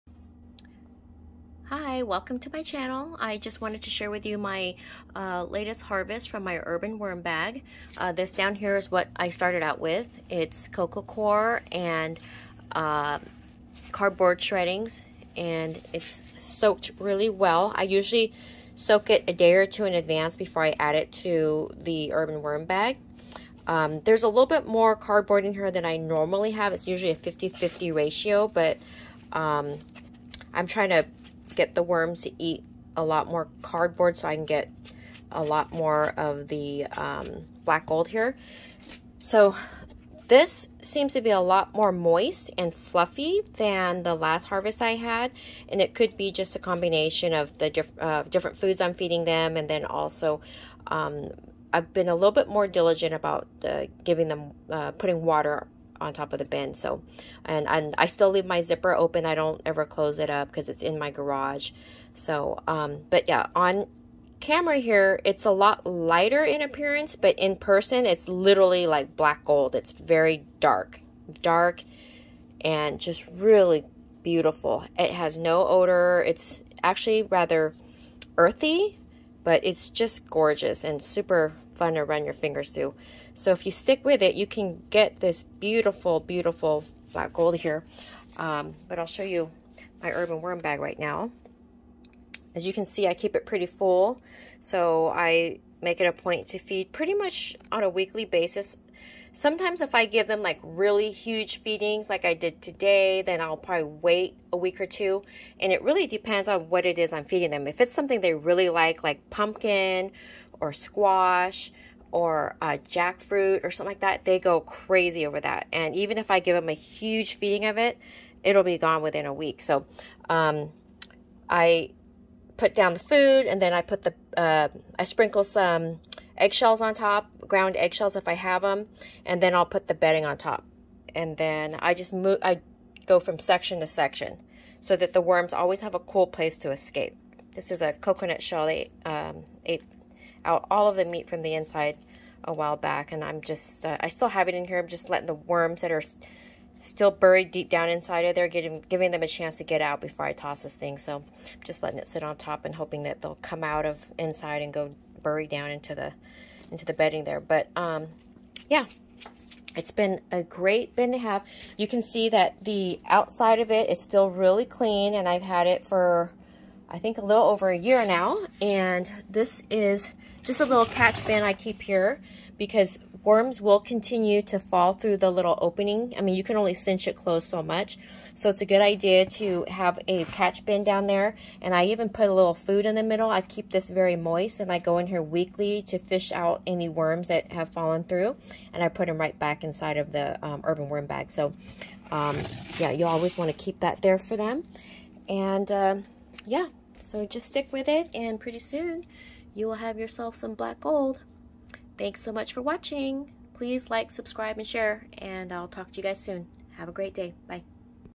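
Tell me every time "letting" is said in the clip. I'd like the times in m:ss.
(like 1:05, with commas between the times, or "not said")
2:25, 2:31.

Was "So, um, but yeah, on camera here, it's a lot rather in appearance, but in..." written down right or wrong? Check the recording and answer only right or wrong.
wrong.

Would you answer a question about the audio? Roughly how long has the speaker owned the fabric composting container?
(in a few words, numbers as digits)
a little over a year.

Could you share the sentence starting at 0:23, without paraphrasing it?
Um, there's a little bit more cardboard in here than I normally have.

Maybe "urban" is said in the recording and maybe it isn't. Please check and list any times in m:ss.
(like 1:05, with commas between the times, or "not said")
0:06, 0:22, 1:30, 3:10.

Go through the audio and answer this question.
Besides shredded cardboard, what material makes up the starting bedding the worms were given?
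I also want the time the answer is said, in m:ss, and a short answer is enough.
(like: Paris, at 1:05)
coco coir, at 0:10.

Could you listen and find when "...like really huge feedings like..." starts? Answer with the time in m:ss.
1:40.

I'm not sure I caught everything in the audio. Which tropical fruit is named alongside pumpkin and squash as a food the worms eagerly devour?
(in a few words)
jackfruit.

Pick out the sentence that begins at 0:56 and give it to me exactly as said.
So, and, and I still leave my zipper open.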